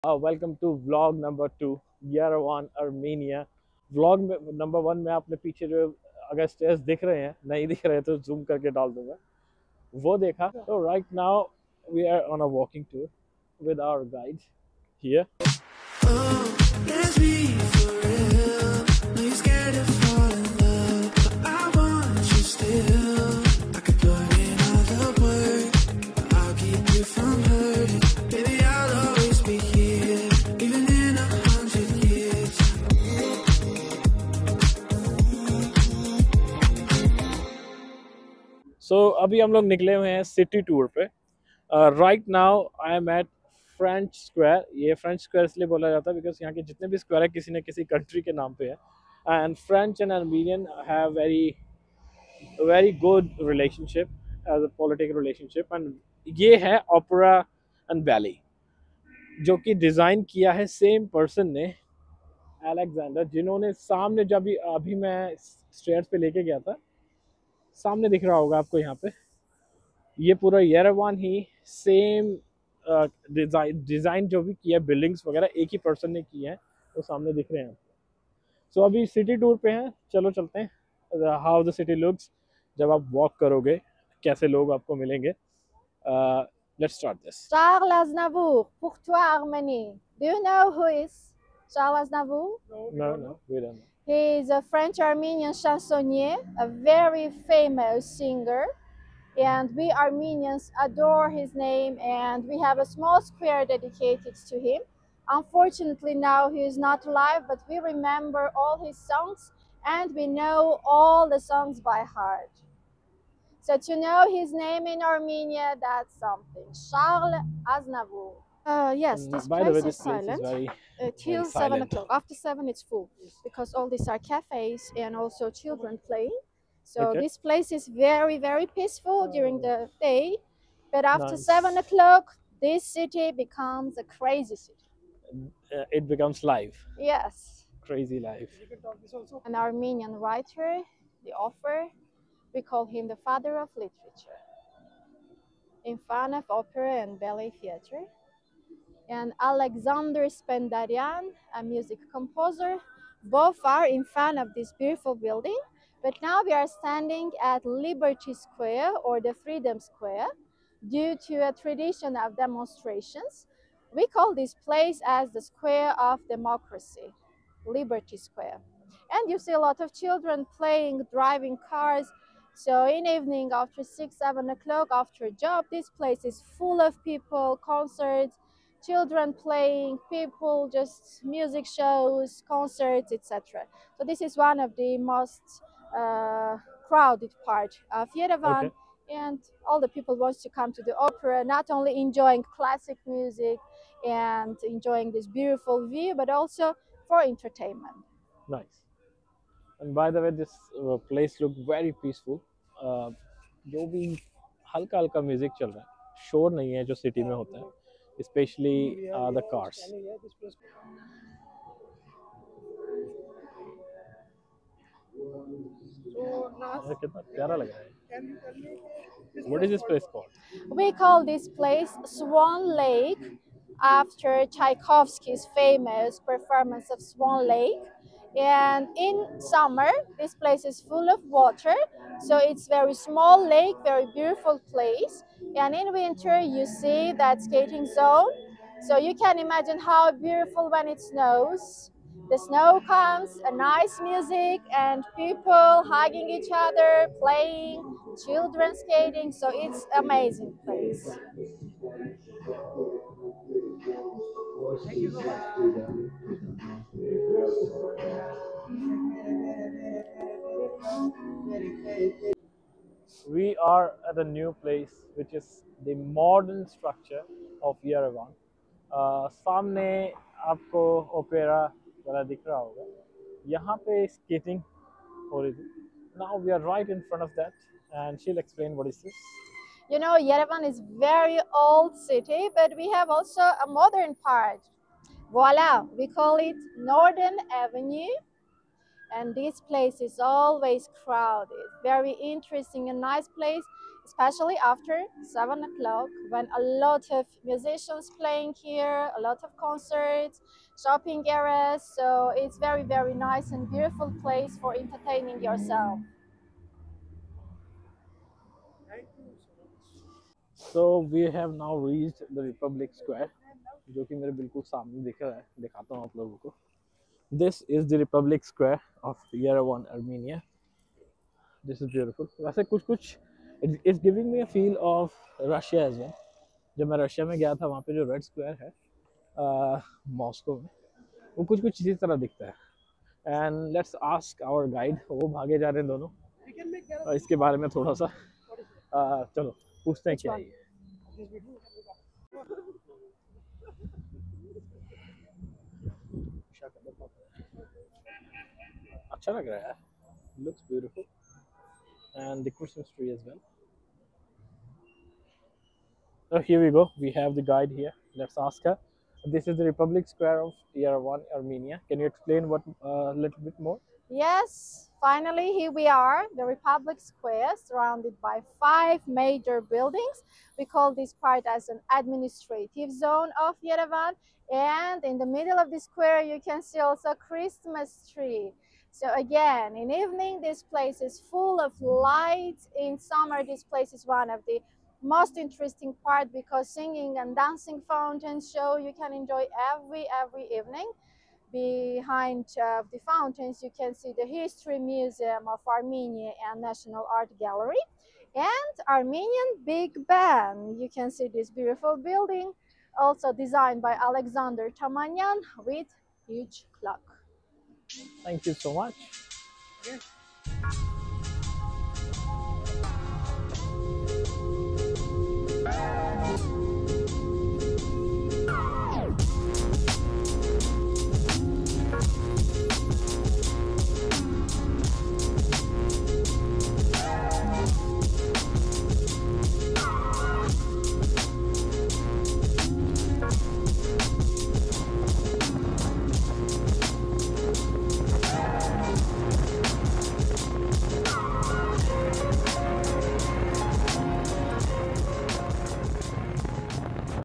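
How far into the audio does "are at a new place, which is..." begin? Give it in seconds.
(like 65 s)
263 s.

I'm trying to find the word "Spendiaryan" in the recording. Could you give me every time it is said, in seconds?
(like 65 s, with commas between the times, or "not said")
150 s.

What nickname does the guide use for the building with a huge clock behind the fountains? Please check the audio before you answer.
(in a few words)
Armenian Big Ben.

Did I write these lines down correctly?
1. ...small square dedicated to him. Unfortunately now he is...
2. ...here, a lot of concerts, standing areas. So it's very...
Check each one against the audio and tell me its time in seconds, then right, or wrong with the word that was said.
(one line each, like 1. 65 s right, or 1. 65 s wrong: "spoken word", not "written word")
1. 102 s right
2. 298 s wrong: "shopping", not "standing".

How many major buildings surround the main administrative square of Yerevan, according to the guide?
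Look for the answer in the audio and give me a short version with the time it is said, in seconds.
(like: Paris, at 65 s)
5, at 368 s.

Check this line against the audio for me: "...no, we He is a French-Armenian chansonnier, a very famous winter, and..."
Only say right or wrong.
wrong.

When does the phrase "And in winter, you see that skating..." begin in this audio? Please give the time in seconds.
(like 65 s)
235 s.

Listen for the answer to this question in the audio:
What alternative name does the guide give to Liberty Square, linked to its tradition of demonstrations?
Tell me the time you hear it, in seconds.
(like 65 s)
165 s.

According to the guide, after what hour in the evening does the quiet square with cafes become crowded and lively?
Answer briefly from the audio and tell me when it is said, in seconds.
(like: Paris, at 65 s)
7, at 121 s.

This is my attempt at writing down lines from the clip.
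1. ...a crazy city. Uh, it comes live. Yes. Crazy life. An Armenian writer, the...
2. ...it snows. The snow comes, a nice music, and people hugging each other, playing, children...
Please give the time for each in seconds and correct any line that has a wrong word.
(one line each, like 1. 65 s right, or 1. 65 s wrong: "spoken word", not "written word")
1. 133 s wrong: "becomes", not "comes"
2. 240 s right.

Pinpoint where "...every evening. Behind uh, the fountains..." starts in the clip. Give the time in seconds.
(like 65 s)
390 s.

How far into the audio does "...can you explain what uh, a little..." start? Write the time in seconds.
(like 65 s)
361 s.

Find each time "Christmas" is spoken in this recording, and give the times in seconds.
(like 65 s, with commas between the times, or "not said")
352 s, 377 s.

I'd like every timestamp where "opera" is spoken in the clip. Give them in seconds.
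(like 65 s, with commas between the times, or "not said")
146 s, 190 s.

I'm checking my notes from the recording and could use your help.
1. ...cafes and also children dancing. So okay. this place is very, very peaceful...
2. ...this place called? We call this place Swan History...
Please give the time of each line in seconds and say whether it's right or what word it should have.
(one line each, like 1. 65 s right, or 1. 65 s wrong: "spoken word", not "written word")
1. 124 s wrong: "playing", not "dancing"
2. 219 s wrong: "Lake", not "History".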